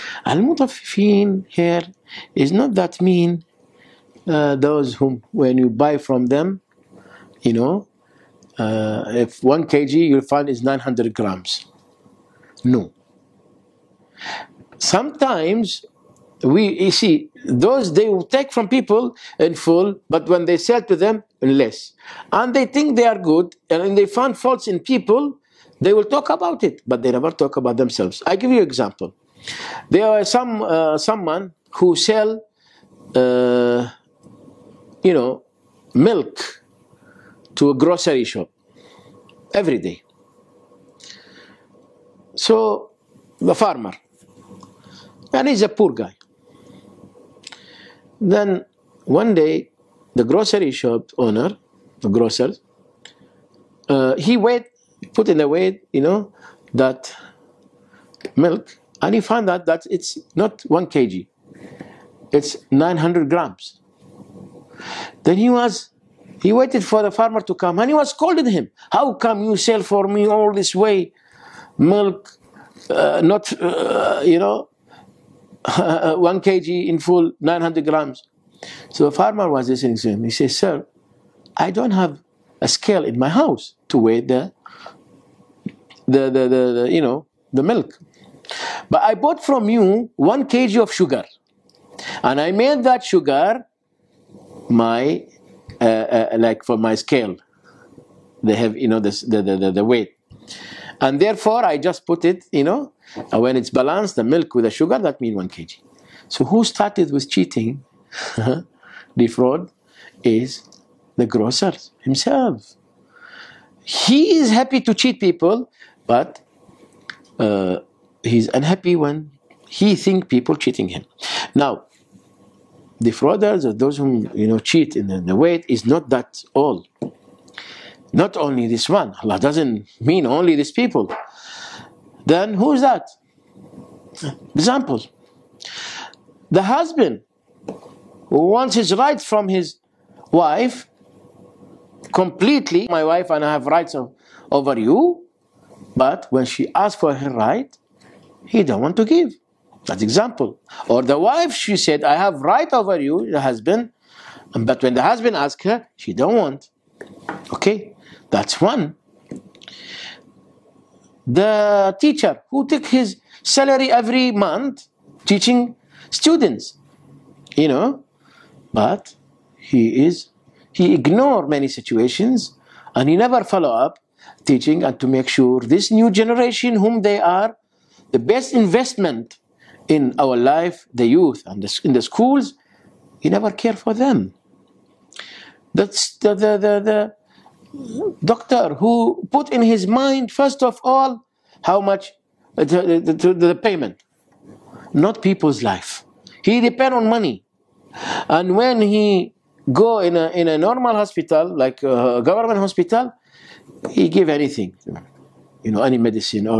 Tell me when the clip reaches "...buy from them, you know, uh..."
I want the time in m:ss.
0:05.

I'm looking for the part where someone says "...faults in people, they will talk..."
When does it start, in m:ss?
0:24.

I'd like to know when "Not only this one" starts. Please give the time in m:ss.
2:08.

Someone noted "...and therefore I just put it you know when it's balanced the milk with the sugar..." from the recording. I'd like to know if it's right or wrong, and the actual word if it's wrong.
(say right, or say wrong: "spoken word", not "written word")
right.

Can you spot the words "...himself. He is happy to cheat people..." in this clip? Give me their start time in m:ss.
1:52.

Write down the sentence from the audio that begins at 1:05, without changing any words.
Then he was, he waited for the farmer to come and he was calling him.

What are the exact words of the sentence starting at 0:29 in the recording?
There are some uh, someone who sell, uh, you know, milk to a grocery shop every day.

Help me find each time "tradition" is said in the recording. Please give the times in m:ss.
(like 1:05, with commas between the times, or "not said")
not said.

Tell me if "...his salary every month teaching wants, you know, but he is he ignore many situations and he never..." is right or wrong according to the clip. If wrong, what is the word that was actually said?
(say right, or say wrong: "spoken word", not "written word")
wrong: "students", not "wants".